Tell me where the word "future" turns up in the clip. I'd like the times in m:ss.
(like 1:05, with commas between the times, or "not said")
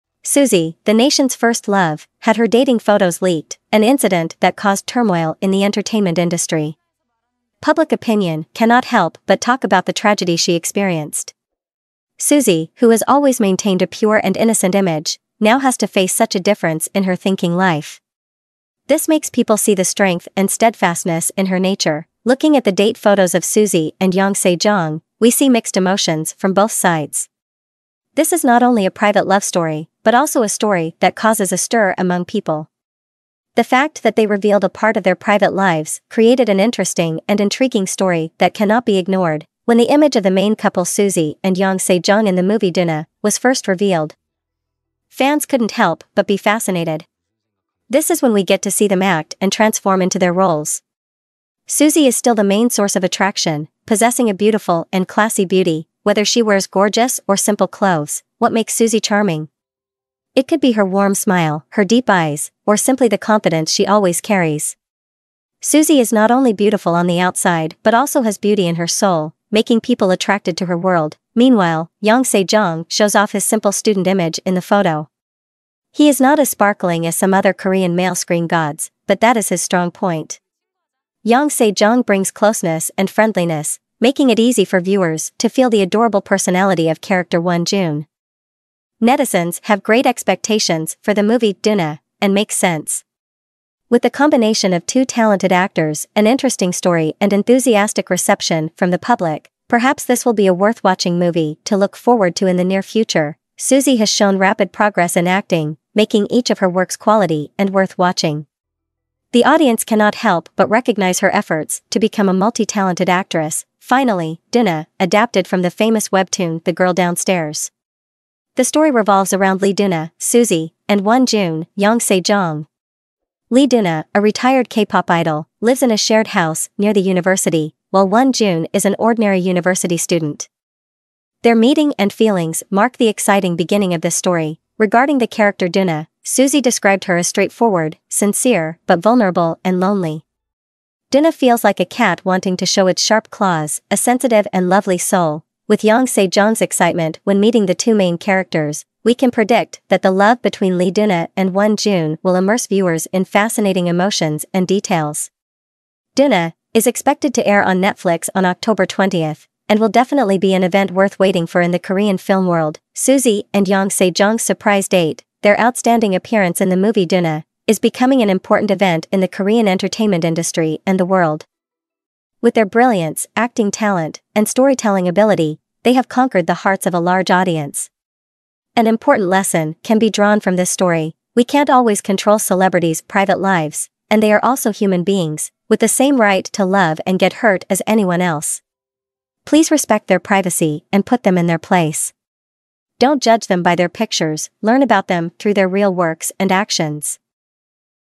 1:42.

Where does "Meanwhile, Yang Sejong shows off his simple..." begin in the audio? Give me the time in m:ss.
1:11.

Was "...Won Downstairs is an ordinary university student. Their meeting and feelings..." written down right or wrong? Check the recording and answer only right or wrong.
wrong.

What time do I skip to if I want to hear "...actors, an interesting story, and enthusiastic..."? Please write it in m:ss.
1:35.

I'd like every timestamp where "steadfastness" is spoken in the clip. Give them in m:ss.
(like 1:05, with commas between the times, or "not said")
0:20.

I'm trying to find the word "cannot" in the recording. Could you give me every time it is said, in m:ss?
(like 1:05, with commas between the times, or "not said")
0:08, 0:38, 1:49.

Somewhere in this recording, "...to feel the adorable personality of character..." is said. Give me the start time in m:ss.
1:25.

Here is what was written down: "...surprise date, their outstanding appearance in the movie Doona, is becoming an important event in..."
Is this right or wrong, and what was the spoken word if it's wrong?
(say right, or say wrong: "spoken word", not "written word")
right.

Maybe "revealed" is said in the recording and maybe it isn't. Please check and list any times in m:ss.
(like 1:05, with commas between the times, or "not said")
0:34, 0:43.